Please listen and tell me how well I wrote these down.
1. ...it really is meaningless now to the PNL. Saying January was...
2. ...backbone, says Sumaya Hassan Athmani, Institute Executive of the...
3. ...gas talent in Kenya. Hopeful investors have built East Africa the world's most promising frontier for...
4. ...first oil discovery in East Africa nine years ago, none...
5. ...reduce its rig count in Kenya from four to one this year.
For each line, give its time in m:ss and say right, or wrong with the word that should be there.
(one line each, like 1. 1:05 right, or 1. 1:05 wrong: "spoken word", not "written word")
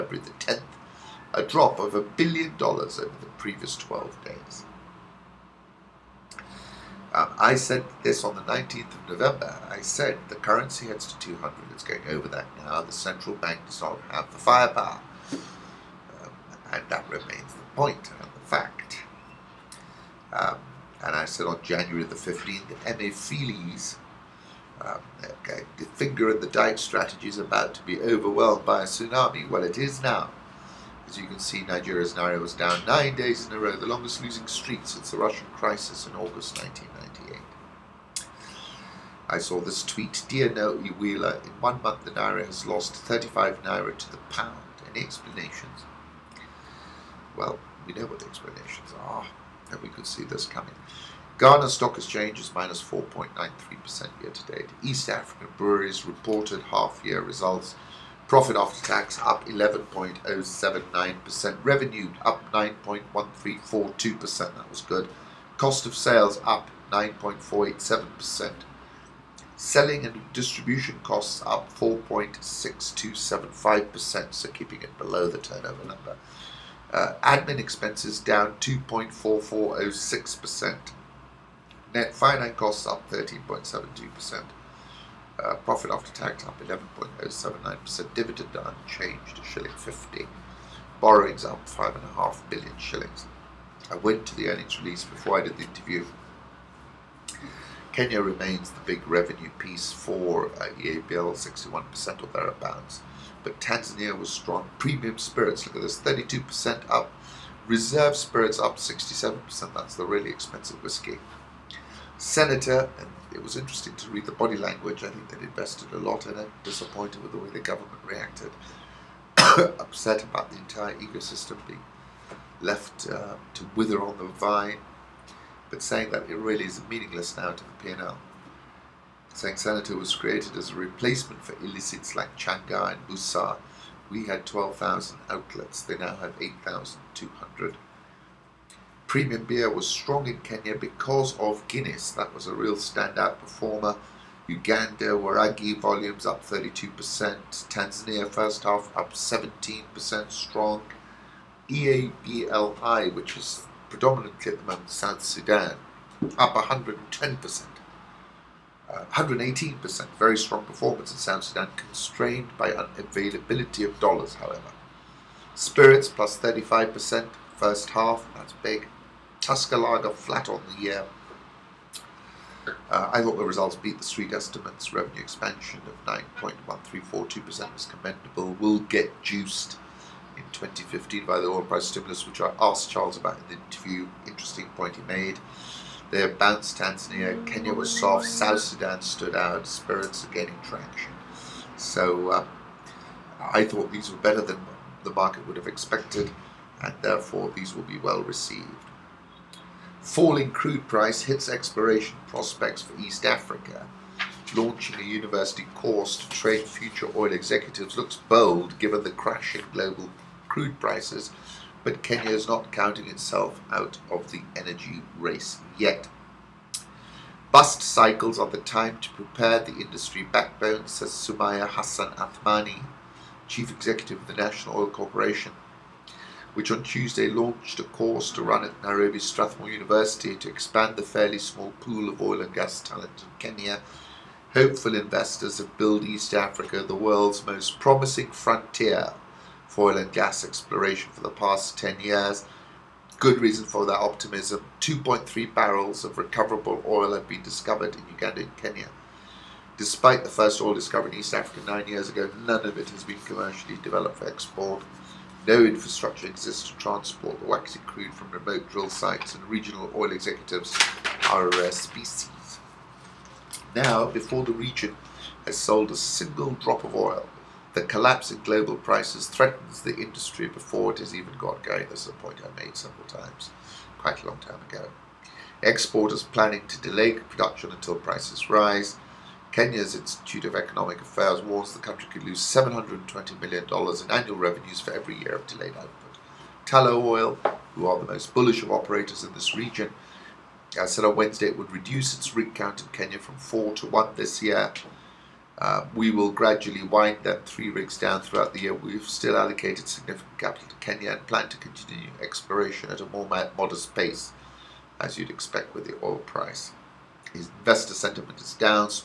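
1. 2:06 wrong: "Senator", not "January"
2. 3:40 wrong: "Chief", not "Institute"
3. 3:52 right
4. 4:10 right
5. 4:51 right.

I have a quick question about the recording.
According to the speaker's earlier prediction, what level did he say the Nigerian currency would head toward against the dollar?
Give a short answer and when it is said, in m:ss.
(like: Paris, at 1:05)
200, at 0:11.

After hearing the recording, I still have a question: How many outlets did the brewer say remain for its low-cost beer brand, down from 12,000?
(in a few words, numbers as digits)
8,200.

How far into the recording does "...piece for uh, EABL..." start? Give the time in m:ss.
1:39.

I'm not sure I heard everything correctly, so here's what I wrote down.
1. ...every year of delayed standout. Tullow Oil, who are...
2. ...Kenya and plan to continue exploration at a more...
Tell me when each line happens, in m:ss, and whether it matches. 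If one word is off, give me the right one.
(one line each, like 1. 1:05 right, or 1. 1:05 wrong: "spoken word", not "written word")
1. 4:44 wrong: "output", not "standout"
2. 5:00 right.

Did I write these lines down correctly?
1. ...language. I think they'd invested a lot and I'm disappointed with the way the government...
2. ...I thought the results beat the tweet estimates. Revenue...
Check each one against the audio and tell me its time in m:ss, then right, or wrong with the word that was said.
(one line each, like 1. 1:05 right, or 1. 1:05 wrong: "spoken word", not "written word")
1. 1:54 right
2. 2:53 wrong: "street", not "tweet".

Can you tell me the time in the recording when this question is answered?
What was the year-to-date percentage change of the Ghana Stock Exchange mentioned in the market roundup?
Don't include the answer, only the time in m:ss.
0:52.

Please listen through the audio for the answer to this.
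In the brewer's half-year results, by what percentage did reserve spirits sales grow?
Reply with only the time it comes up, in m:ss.
1:48.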